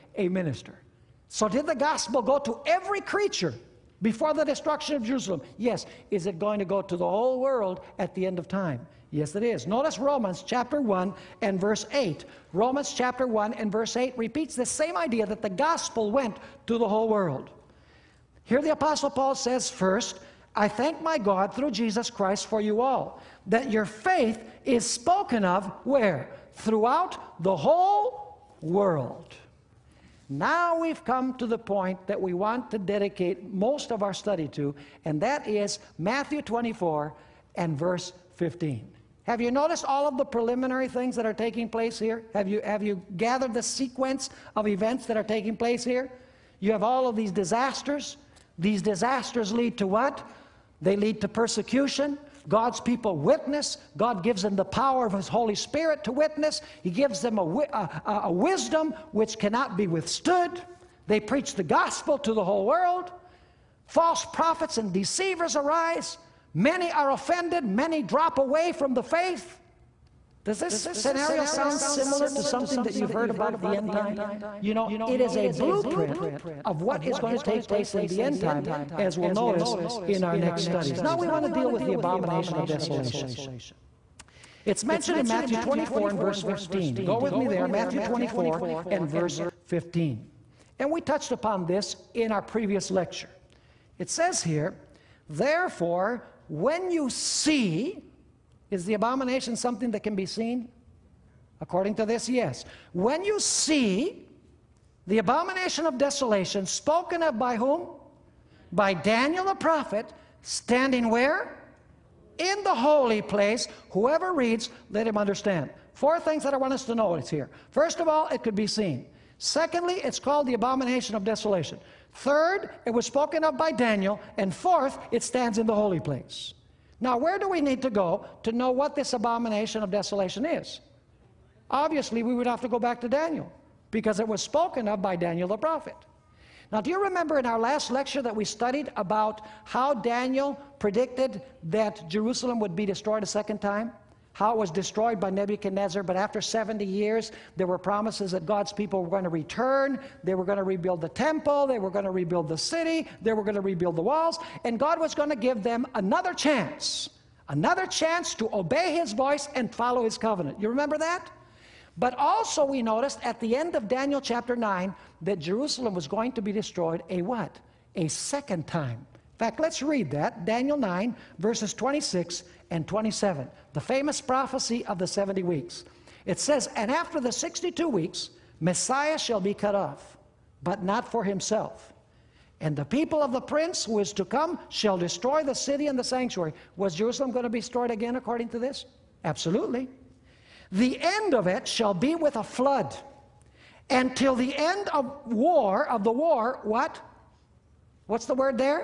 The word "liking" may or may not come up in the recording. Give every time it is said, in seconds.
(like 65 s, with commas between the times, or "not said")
not said.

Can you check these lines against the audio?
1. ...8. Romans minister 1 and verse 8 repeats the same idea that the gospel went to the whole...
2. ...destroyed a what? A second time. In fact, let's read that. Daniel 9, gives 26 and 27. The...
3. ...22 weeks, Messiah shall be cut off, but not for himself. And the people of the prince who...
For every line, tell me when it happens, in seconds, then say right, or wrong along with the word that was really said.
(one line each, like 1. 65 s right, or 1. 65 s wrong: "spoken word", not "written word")
1. 11 s wrong: "chapter", not "minister"
2. 166 s wrong: "verses", not "gives"
3. 177 s wrong: "62", not "22".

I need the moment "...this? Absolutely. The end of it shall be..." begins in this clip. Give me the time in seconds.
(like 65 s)
188 s.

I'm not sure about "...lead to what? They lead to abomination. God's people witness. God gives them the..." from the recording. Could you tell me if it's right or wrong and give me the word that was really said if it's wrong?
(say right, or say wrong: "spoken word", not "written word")
wrong: "persecution", not "abomination".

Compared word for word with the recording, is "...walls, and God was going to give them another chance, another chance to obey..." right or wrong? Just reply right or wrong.
right.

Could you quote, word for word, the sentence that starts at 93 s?
It says here, therefore, when you see, is the abomination something that can be seen?